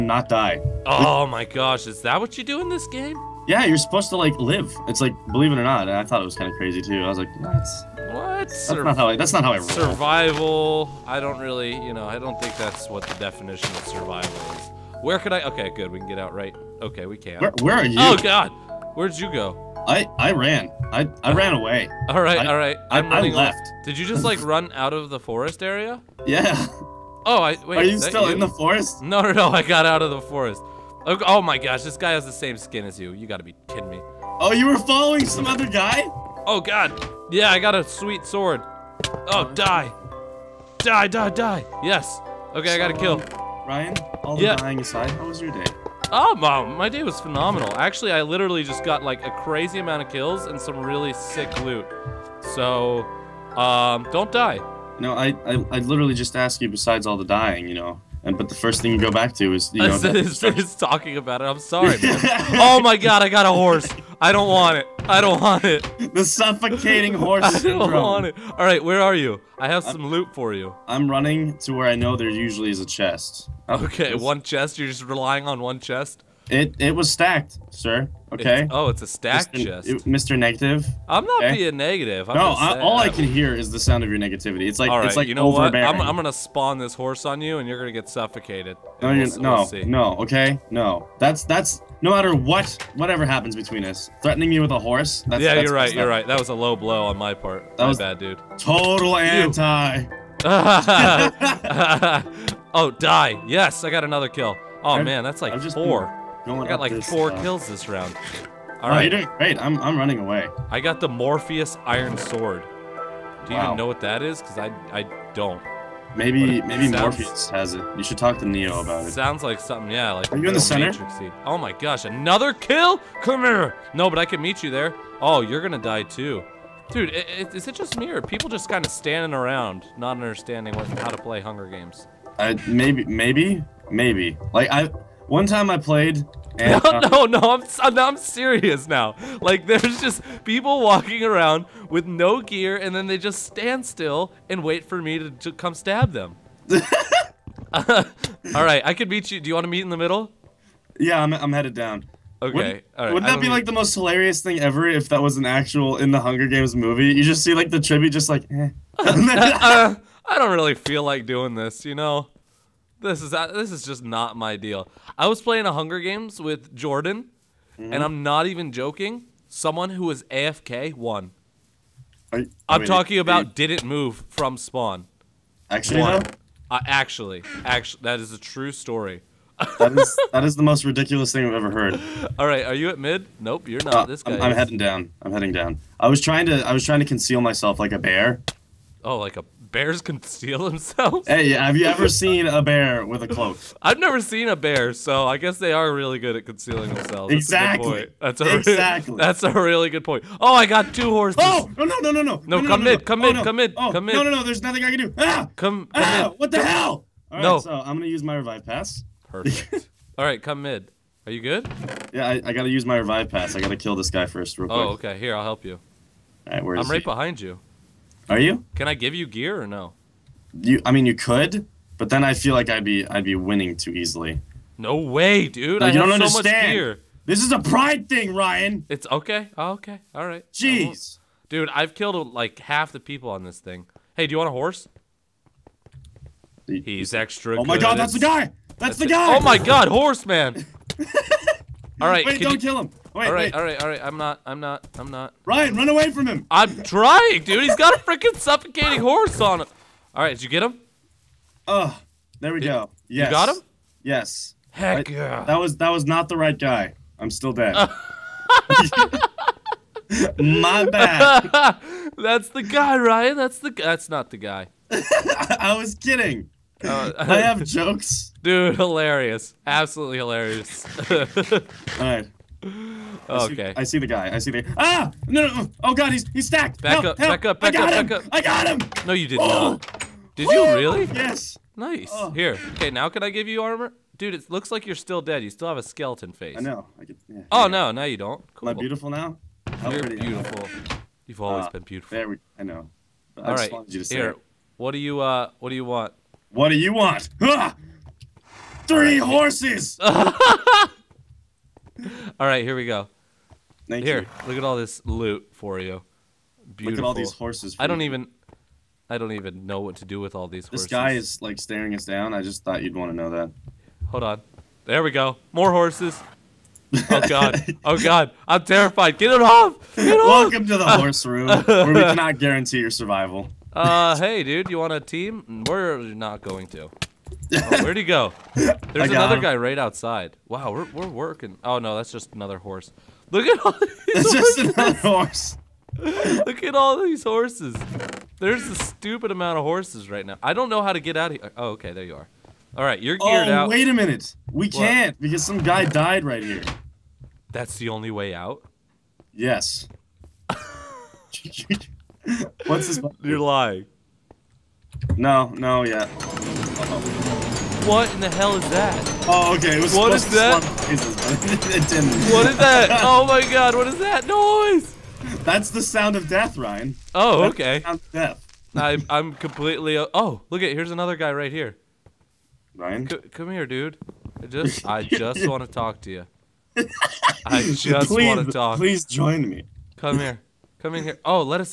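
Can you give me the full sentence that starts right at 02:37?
You just see like the tribute, just like.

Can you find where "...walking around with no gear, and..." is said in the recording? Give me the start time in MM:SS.
02:20.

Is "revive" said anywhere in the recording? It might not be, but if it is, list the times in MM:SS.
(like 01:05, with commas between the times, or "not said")
03:28, 03:32.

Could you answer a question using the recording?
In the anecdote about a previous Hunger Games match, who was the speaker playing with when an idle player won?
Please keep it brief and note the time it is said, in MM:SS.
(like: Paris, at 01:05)
Jordan, at 02:46.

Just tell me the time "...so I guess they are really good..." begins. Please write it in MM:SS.
03:14.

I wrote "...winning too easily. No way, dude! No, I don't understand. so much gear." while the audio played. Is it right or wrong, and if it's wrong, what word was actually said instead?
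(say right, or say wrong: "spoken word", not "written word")
right.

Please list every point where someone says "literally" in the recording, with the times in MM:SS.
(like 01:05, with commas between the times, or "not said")
00:48, 00:55.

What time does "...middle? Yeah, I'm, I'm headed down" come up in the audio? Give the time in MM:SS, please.
02:29.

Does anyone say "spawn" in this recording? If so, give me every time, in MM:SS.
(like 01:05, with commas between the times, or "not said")
01:26, 02:54.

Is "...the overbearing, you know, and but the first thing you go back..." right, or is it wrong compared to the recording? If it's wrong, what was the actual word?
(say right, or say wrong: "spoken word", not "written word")
wrong: "dying", not "overbearing".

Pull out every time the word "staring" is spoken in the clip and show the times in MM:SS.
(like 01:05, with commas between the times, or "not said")
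05:11.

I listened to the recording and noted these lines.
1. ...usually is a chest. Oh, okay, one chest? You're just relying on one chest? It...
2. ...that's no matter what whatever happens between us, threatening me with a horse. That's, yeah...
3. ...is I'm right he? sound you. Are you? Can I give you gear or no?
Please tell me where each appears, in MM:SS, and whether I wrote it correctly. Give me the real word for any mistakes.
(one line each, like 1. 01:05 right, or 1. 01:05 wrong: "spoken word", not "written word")
1. 01:12 right
2. 01:31 right
3. 03:36 wrong: "behind", not "sound".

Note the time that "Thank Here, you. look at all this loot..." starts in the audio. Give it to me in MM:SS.
05:03.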